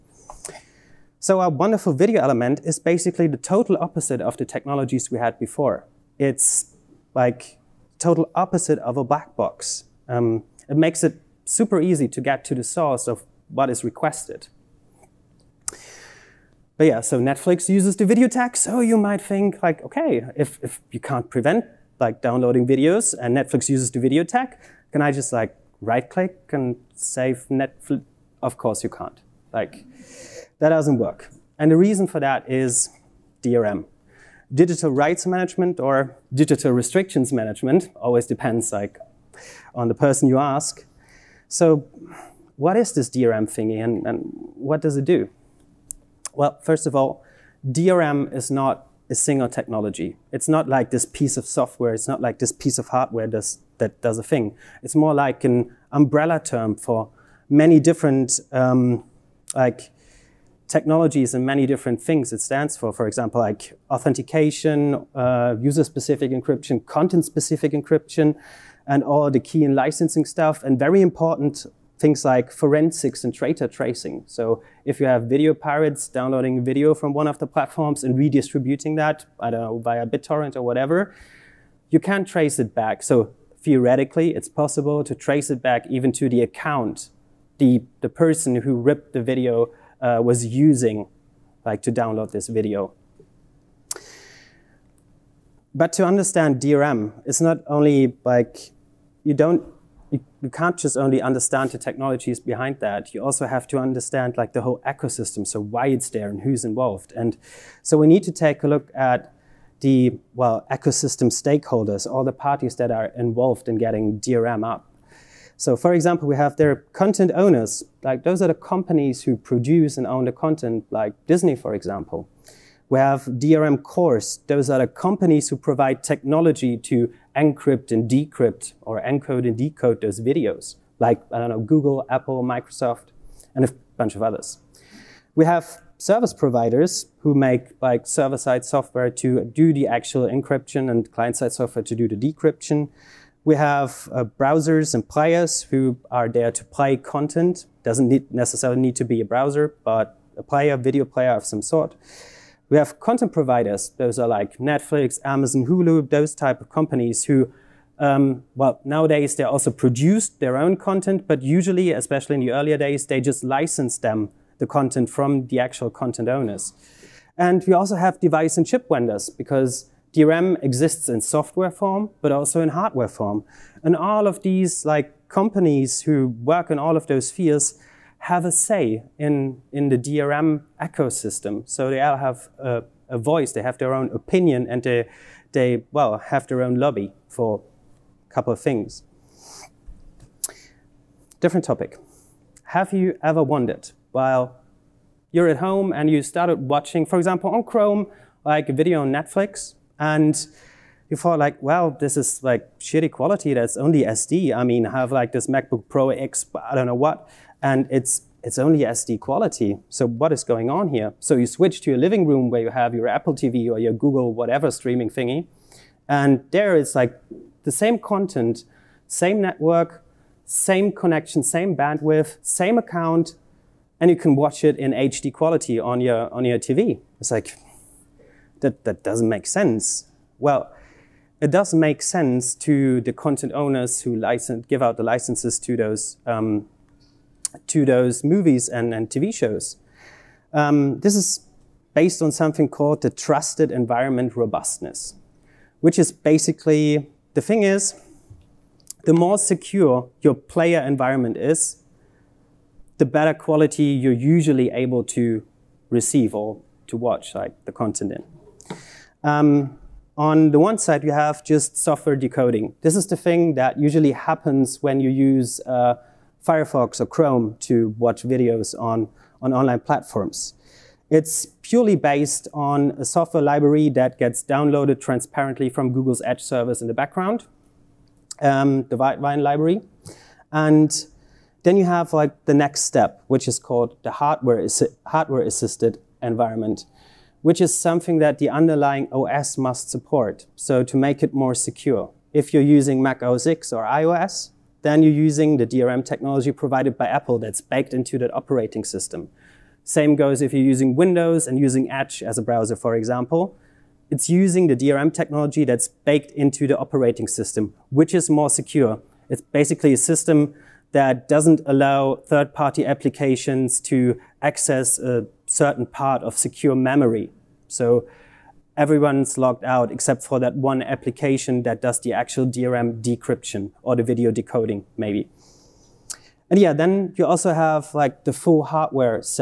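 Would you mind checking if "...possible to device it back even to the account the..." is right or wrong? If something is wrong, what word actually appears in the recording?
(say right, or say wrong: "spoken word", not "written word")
wrong: "trace", not "device".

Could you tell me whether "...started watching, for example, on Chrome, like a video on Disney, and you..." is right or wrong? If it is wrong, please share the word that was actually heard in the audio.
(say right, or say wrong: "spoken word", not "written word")
wrong: "Netflix", not "Disney".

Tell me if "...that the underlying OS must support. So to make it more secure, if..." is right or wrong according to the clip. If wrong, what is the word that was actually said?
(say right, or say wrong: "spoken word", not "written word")
right.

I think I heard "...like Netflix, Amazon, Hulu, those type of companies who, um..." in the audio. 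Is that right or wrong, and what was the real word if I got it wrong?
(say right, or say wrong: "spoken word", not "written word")
right.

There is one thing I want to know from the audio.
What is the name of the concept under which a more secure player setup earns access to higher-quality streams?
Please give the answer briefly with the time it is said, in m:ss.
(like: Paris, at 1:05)
trusted environment robustness, at 4:03.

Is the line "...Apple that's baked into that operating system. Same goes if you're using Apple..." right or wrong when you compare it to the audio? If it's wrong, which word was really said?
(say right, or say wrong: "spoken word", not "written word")
wrong: "Windows", not "Apple".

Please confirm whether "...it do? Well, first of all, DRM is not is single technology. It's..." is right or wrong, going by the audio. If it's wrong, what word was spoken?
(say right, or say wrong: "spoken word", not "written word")
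right.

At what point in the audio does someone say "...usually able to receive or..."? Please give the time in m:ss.
4:14.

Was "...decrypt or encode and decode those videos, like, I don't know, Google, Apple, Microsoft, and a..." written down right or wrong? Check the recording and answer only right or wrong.
right.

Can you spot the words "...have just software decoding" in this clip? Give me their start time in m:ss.
4:21.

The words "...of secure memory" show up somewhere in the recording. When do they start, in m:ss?
5:16.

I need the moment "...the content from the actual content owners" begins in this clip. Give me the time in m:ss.
2:44.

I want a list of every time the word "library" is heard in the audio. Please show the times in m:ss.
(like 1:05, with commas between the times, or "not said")
4:33, 4:39.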